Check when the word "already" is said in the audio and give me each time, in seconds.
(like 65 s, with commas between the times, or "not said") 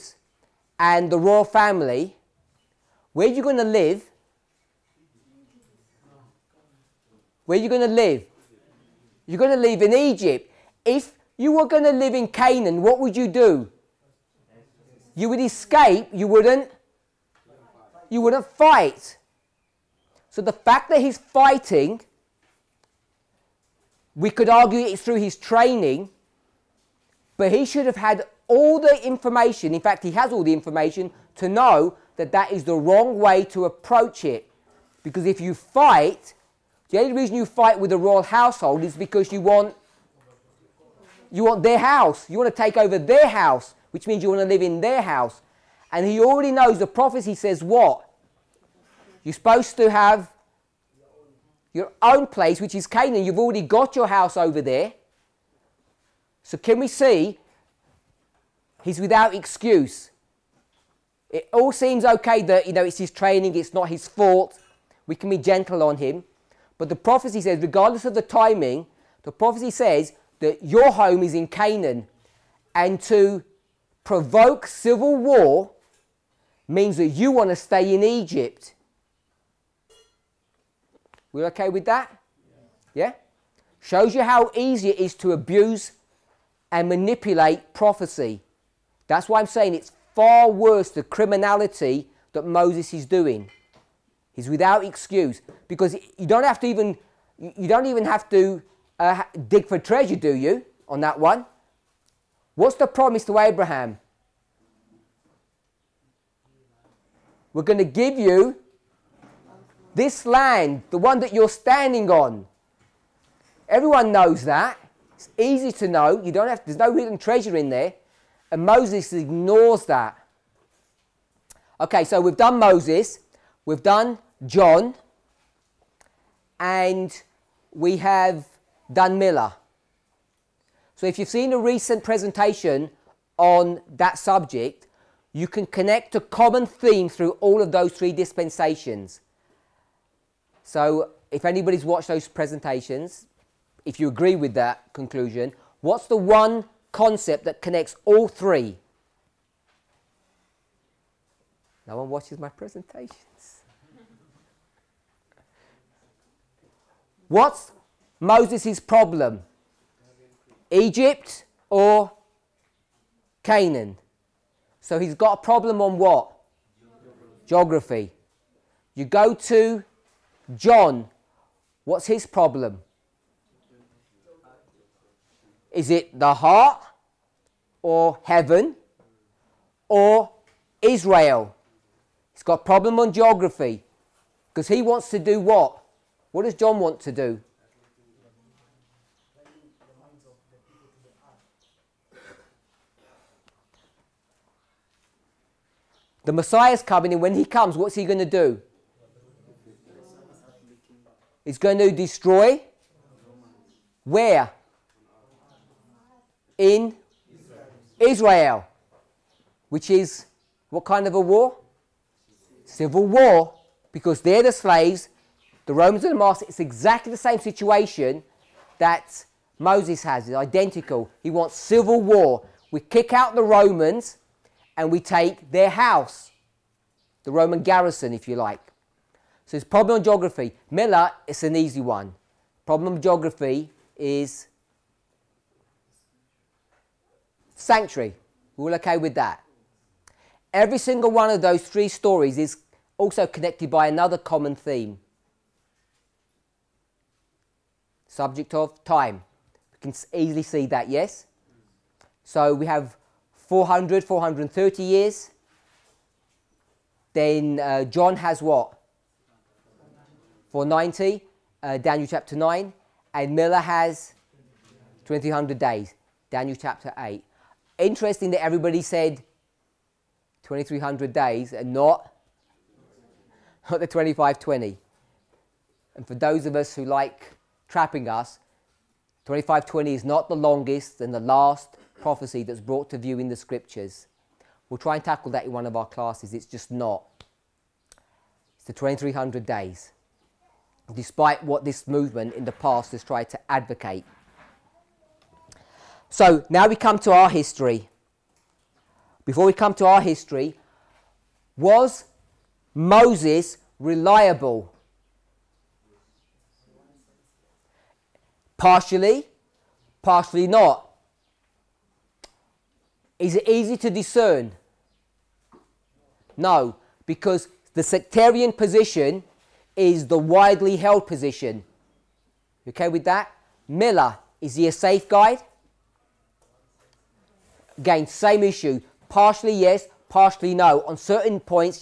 46 s, 53 s.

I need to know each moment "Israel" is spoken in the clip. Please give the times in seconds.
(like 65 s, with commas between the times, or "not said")
180 s, 207 s.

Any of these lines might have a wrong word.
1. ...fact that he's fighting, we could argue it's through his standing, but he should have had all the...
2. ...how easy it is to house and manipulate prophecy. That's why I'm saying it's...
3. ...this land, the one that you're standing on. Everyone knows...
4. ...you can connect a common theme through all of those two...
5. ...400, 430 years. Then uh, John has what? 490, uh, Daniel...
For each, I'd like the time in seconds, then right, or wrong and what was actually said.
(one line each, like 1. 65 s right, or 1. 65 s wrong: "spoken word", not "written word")
1. 20 s wrong: "training", not "standing"
2. 84 s wrong: "abuse", not "house"
3. 109 s right
4. 135 s wrong: "three", not "two"
5. 253 s right.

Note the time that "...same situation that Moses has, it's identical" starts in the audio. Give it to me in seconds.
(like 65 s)
217 s.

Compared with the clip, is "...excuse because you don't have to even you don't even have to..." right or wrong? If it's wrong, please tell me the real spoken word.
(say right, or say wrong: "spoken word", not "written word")
right.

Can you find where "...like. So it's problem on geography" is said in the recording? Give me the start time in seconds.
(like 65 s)
228 s.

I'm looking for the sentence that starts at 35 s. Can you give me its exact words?
Because if you fight, the only reason you fight with the royal household is because you want you want their house.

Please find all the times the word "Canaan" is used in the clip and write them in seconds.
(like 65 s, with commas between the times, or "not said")
12 s, 52 s, 71 s, 163 s.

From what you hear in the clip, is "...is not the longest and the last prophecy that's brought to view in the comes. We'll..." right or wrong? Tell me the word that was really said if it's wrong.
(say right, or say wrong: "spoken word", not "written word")
wrong: "scriptures", not "comes".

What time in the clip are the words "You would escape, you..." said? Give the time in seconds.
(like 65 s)
15 s.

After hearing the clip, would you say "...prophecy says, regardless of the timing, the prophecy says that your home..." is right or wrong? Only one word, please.
right.